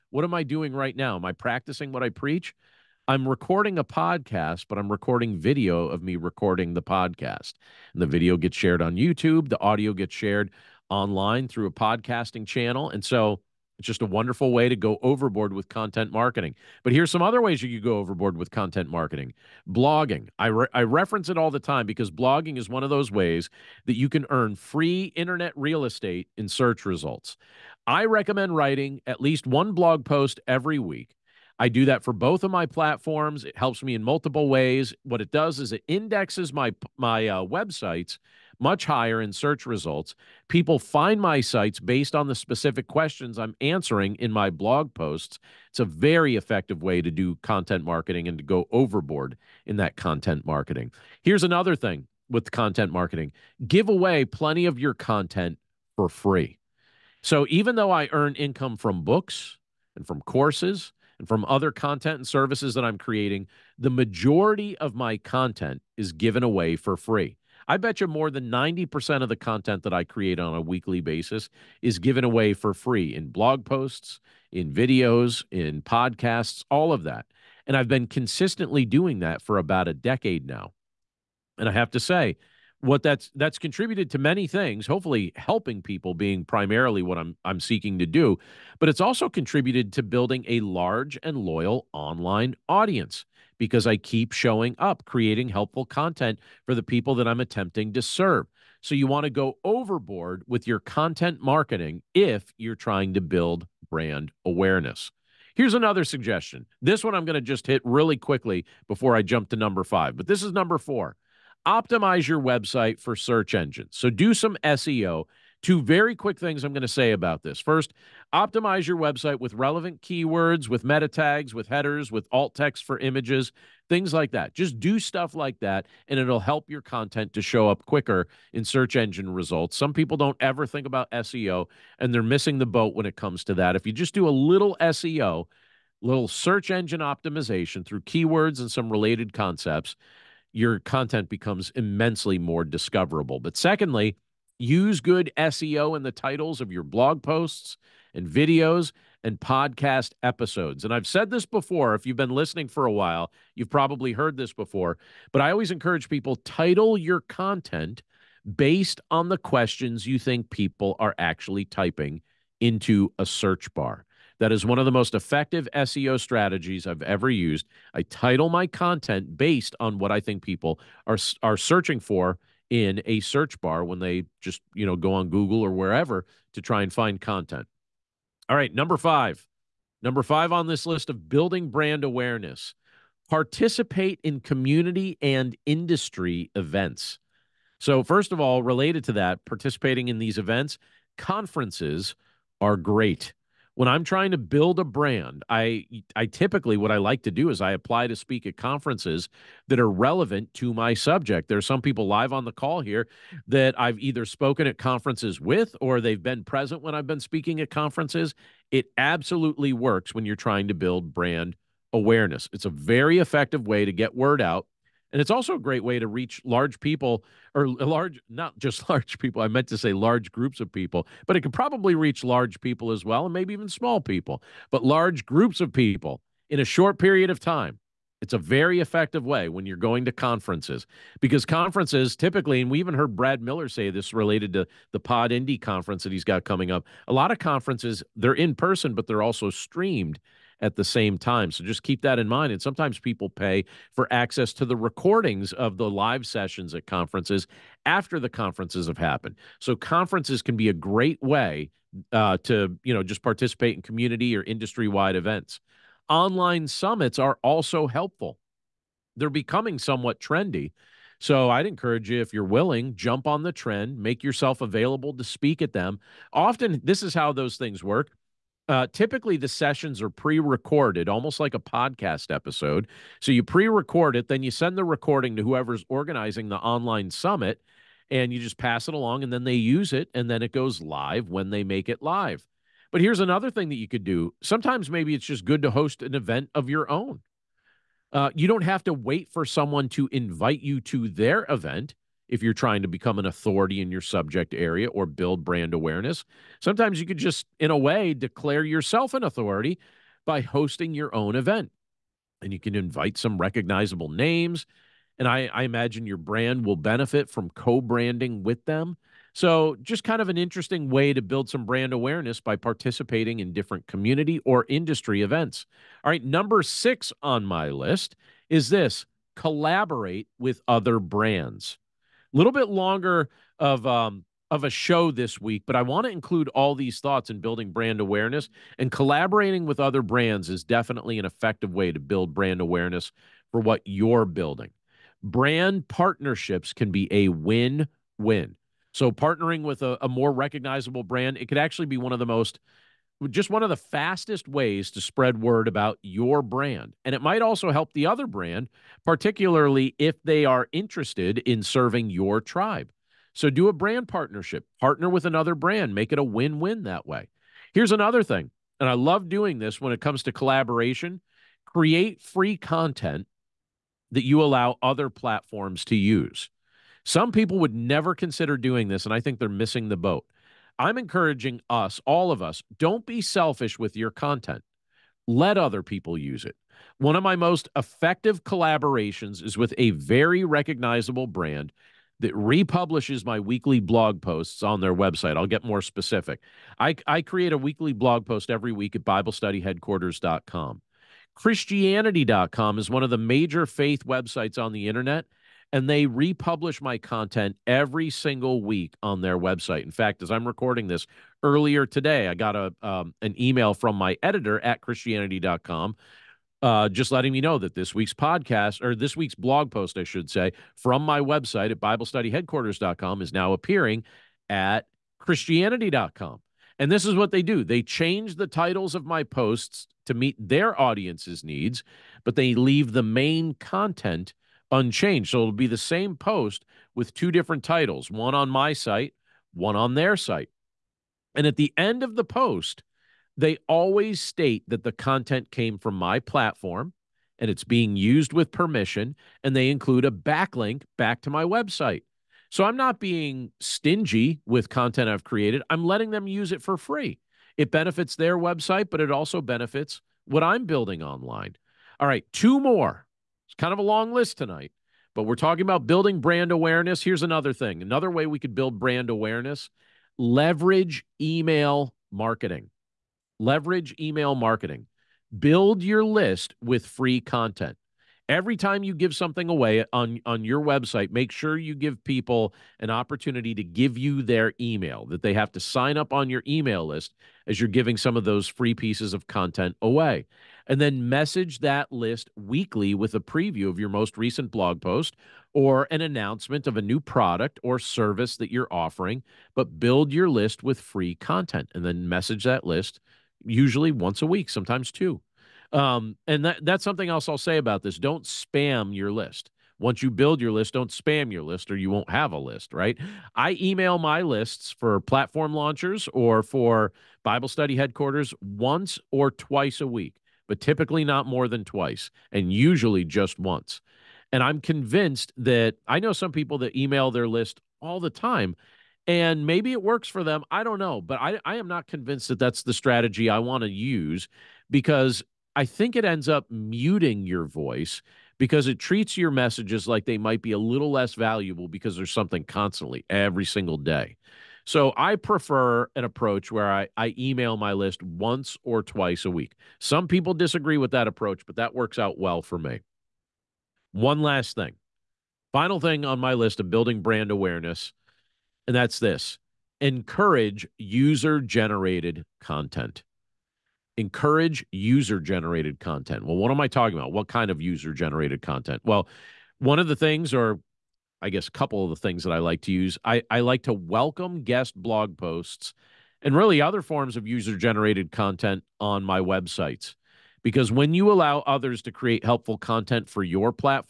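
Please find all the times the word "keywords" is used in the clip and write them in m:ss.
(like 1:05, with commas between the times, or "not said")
2:00, 2:17.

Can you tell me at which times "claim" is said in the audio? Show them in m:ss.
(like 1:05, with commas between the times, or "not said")
not said.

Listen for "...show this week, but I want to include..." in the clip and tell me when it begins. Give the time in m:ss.
5:24.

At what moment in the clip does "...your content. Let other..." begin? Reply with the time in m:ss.
6:13.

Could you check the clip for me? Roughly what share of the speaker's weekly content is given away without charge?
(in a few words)
more than 90%.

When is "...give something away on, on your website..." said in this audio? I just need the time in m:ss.
7:48.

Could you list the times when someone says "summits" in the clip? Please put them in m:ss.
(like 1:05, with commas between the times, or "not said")
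4:16, 4:37.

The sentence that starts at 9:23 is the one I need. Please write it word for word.
I, I like to welcome guest blog posts and really other forms of user generated content on my websites.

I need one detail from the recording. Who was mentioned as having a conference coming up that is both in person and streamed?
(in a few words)
Brad Miller.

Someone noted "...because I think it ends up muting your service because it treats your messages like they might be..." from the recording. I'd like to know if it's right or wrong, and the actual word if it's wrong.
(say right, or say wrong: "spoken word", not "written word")
wrong: "voice", not "service".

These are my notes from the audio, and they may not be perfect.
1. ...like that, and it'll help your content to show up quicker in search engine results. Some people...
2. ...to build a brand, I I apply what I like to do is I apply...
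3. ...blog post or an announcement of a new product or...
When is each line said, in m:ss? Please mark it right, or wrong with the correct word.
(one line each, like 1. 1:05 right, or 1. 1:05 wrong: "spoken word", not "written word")
1. 2:05 right
2. 3:14 wrong: "typically", not "apply"
3. 8:04 right.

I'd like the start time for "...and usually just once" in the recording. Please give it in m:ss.
8:32.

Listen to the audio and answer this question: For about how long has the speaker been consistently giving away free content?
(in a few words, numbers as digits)
about a decade.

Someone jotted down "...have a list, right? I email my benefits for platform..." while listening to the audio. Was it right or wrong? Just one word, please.
wrong.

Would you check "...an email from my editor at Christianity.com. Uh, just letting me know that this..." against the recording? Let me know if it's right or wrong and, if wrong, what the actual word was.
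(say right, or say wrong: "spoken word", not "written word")
right.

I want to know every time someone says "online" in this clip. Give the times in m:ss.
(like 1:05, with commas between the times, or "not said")
0:10, 1:31, 4:16, 4:36, 7:31.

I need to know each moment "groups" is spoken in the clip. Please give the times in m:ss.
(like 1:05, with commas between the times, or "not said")
3:40, 3:45.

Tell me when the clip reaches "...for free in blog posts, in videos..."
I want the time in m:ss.
1:12.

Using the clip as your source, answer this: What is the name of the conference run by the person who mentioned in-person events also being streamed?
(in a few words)
PodIndy.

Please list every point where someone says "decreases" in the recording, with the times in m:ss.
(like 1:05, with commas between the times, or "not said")
not said.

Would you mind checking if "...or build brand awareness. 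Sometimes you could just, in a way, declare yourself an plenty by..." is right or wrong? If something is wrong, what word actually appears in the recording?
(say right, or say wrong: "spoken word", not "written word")
wrong: "authority", not "plenty".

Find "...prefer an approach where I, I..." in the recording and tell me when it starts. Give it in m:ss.
8:55.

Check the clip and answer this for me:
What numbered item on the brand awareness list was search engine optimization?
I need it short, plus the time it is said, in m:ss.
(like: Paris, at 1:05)
4, at 1:50.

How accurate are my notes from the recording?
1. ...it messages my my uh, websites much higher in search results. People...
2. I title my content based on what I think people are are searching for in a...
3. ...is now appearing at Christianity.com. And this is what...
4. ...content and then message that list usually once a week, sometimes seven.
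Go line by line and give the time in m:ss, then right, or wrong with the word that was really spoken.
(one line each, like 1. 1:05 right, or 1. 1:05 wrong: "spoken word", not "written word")
1. 0:35 wrong: "indexes", not "messages"
2. 2:47 right
3. 6:53 right
4. 8:11 wrong: "two", not "seven".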